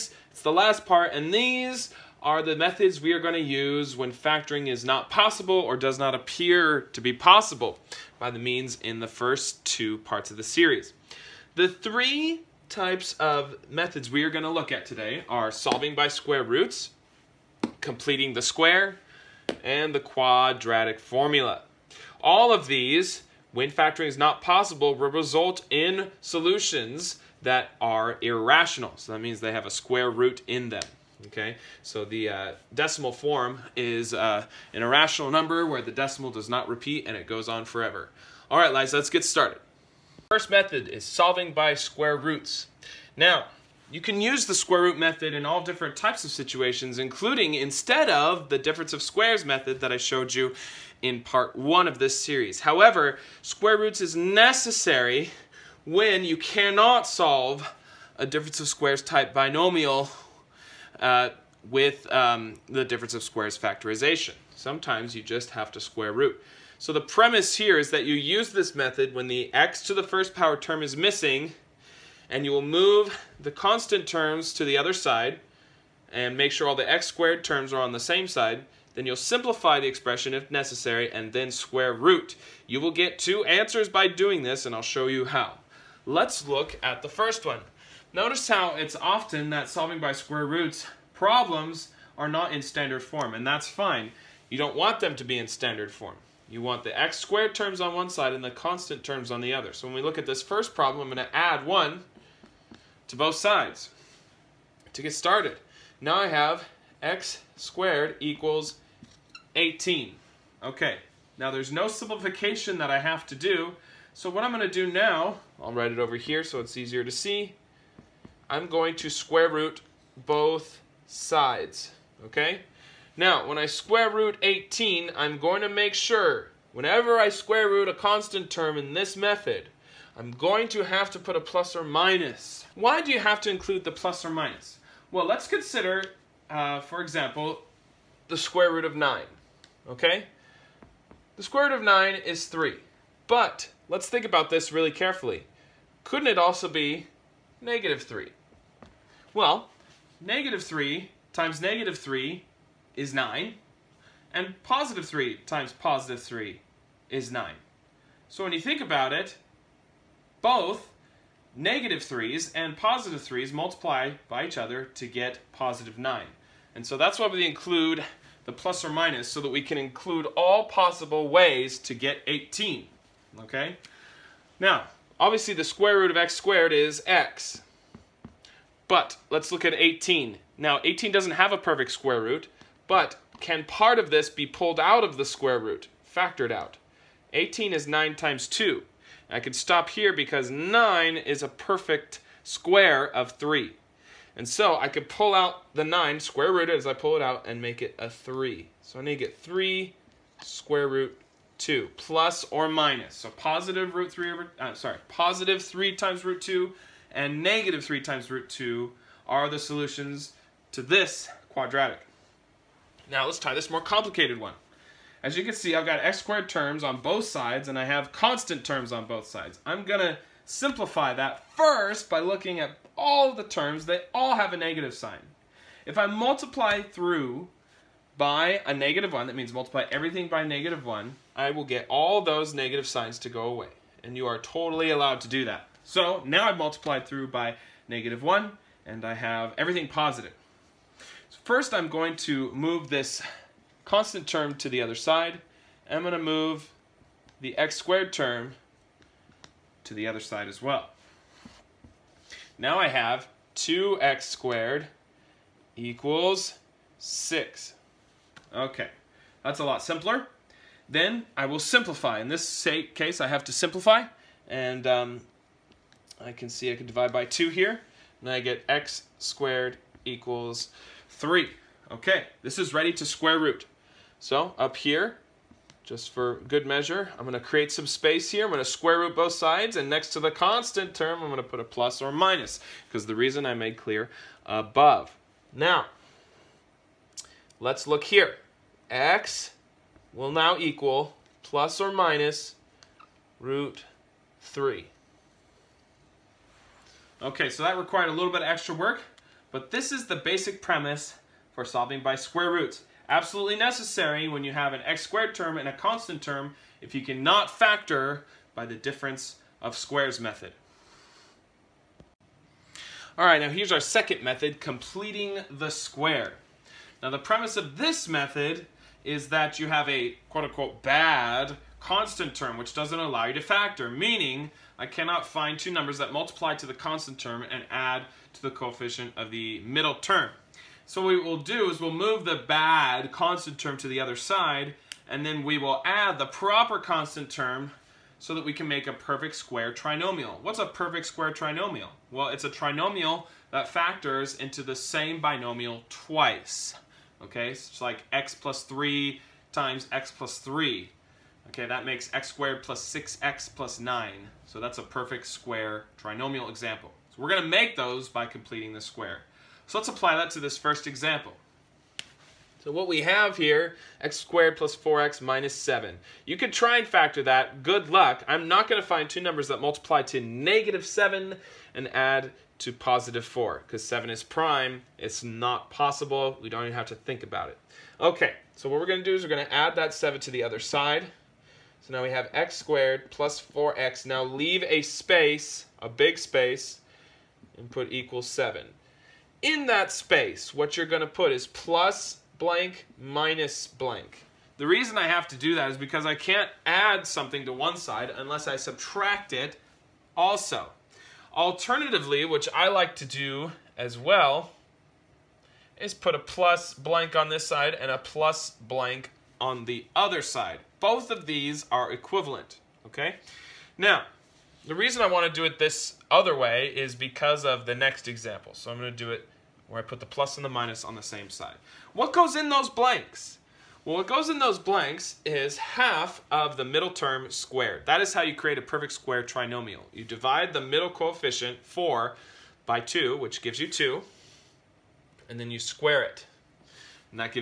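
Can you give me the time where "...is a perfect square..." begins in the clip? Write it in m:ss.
3:11.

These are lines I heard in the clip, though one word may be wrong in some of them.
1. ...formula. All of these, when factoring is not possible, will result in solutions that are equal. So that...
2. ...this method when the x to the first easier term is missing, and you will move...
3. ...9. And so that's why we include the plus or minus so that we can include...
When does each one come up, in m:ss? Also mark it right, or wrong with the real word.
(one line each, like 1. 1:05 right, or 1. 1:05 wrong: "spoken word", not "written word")
1. 0:20 wrong: "irrational", not "equal"
2. 1:08 wrong: "power", not "easier"
3. 2:45 right.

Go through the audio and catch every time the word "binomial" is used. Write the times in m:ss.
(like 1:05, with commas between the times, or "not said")
0:59, 5:45.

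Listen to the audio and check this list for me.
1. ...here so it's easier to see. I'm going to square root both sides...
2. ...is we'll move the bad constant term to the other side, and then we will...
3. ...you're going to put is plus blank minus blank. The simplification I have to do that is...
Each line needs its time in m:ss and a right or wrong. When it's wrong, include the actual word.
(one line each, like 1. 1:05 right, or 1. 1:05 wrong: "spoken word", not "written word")
1. 1:56 right
2. 5:31 right
3. 6:30 wrong: "reason", not "simplification".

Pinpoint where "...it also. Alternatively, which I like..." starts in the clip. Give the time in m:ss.
6:39.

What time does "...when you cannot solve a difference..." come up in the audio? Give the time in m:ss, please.
0:55.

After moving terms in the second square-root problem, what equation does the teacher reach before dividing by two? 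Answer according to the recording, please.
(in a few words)
2x squared equals 6.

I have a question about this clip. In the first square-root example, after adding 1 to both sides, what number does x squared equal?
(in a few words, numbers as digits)
18.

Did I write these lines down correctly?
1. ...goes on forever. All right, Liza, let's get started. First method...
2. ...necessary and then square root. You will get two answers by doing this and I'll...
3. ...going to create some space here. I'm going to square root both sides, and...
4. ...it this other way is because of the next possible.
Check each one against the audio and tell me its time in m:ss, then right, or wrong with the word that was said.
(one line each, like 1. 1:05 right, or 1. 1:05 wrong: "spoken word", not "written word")
1. 0:37 right
2. 1:20 right
3. 4:37 right
4. 6:55 wrong: "example", not "possible".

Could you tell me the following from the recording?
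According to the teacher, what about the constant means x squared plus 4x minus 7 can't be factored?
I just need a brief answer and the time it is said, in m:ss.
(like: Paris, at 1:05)
7 is prime, at 6:13.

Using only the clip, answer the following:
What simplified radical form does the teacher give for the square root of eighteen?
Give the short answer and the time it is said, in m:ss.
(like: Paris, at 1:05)
3 square root 2, at 3:19.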